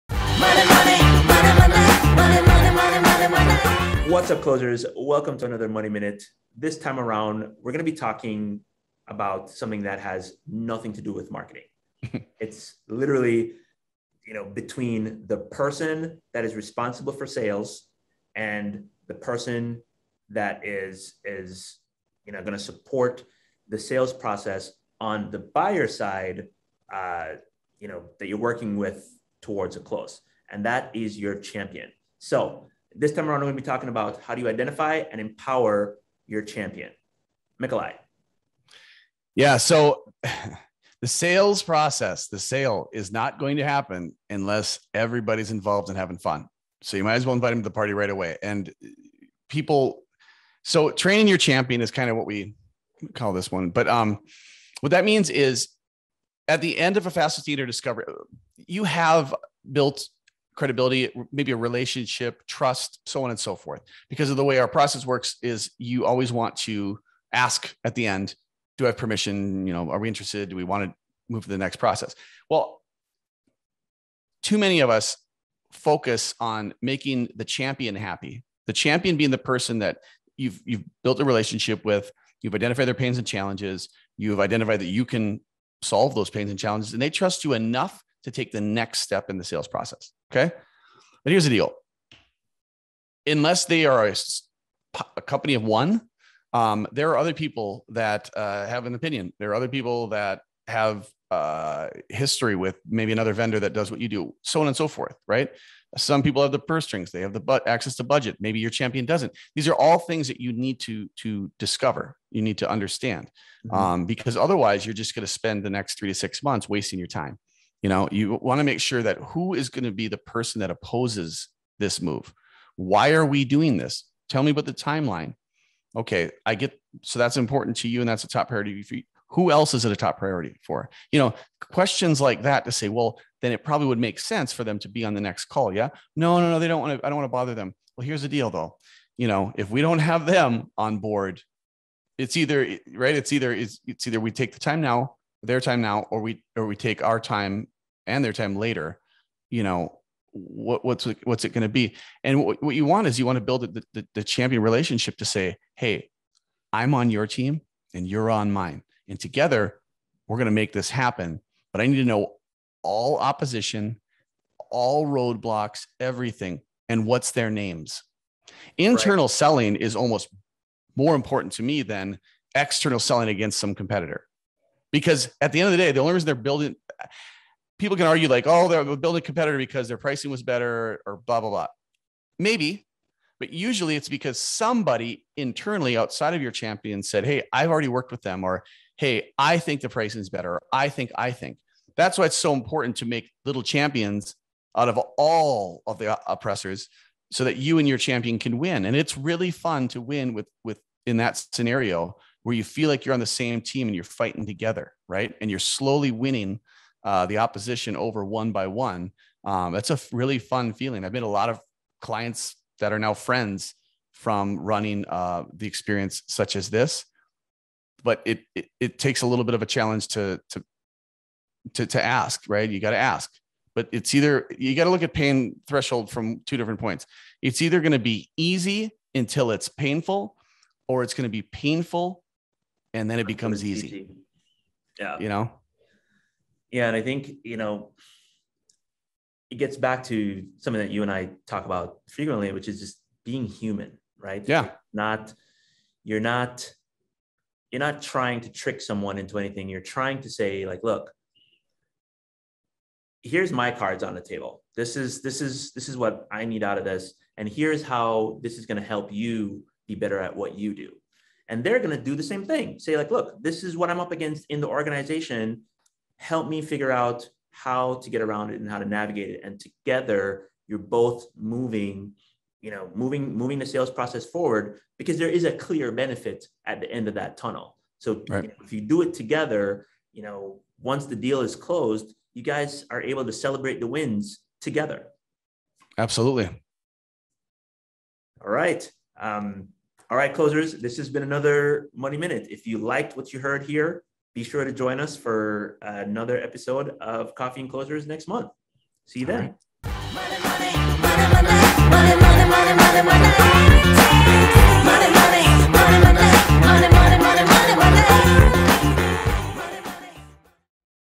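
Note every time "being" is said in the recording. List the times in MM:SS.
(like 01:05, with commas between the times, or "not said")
01:19, 04:03.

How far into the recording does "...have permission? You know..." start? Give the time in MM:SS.
01:08.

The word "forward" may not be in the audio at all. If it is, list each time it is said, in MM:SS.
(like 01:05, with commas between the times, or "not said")
04:34.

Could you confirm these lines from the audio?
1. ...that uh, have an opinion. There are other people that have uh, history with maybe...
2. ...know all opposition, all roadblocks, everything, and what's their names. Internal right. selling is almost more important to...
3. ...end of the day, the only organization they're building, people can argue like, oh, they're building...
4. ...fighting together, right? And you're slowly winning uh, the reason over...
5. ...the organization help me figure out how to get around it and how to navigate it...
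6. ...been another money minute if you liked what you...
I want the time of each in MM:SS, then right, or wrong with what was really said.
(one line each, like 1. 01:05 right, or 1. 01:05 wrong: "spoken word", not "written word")
1. 01:37 right
2. 02:42 right
3. 02:55 wrong: "reason", not "organization"
4. 03:24 wrong: "opposition", not "reason"
5. 04:24 right
6. 04:51 right.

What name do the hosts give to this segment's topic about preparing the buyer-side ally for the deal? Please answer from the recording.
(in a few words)
training your champion.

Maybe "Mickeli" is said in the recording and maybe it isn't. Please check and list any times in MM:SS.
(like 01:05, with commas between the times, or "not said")
00:37.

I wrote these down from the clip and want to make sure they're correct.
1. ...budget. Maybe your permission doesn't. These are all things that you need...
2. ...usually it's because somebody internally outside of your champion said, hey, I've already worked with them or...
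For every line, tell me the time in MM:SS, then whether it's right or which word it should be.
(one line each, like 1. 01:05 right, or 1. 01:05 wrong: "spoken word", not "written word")
1. 01:48 wrong: "champion", not "permission"
2. 03:03 right.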